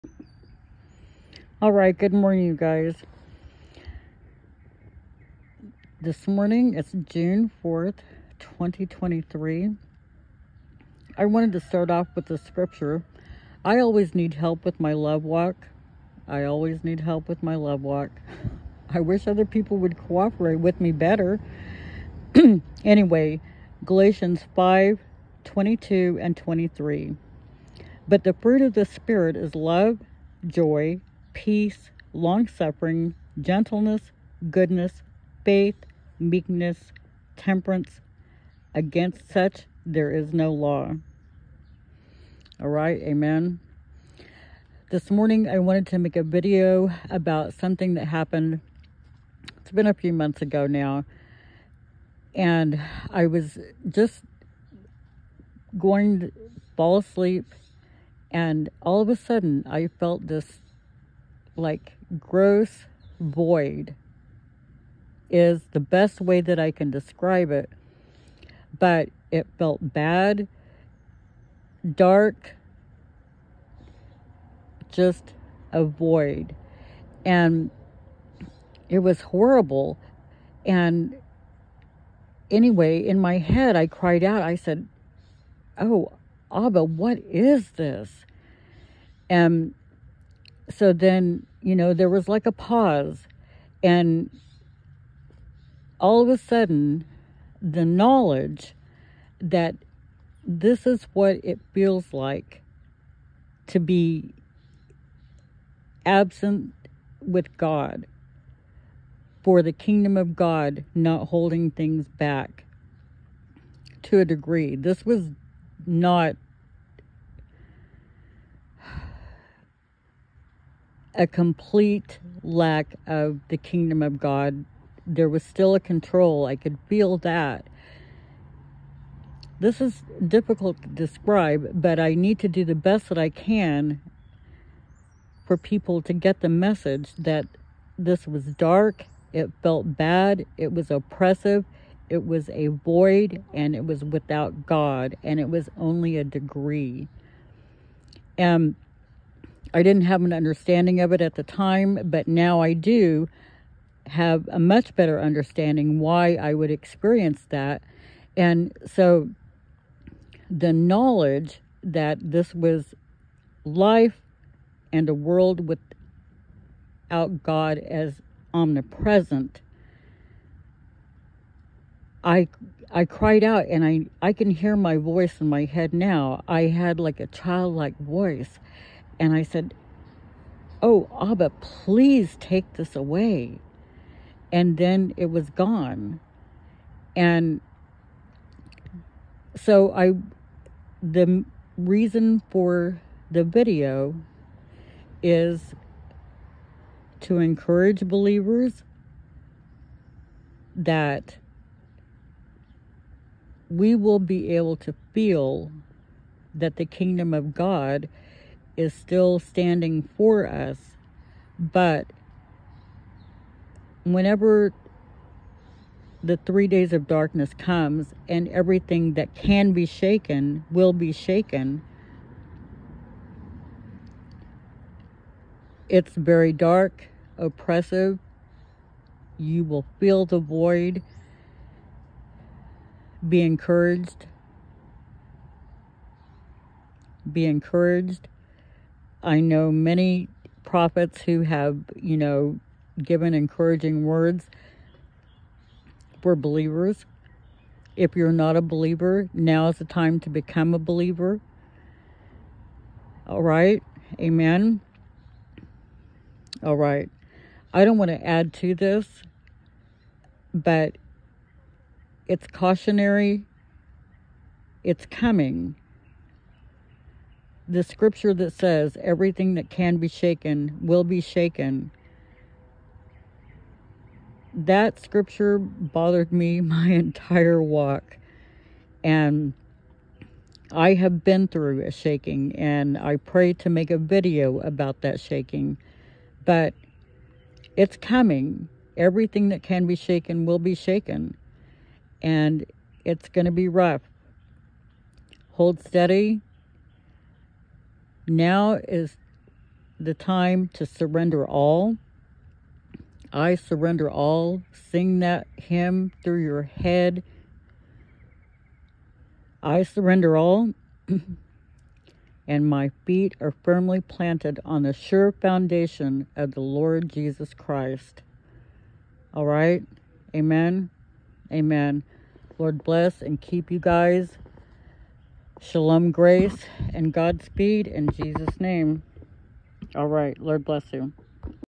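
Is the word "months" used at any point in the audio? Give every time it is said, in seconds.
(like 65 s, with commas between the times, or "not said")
50 s.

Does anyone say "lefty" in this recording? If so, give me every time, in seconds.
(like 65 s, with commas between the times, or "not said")
not said.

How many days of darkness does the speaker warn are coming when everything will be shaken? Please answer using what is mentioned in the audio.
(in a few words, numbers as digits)
3.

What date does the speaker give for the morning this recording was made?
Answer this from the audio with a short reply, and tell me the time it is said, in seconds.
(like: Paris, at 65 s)
June 4th, 2023, at 7 s.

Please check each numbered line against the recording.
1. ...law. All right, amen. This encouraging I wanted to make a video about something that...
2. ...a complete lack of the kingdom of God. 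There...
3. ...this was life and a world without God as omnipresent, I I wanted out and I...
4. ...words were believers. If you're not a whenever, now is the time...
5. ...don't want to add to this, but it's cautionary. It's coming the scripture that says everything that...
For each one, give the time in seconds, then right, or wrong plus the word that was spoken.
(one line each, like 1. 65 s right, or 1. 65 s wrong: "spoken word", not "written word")
1. 40 s wrong: "morning", not "encouraging"
2. 121 s right
3. 162 s wrong: "cried", not "wanted"
4. 244 s wrong: "believer", not "whenever"
5. 257 s right.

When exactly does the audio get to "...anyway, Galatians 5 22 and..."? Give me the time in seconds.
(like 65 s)
22 s.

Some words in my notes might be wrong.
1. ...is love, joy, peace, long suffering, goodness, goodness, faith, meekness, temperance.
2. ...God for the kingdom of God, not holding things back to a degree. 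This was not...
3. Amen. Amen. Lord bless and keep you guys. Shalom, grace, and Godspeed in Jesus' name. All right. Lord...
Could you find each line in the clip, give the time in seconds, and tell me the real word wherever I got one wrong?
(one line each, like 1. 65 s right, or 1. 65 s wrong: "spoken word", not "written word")
1. 29 s wrong: "gentleness", not "goodness"
2. 107 s right
3. 320 s right.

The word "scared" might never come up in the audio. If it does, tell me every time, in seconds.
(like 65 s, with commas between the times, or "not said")
not said.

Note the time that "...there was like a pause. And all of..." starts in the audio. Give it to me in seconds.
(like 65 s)
91 s.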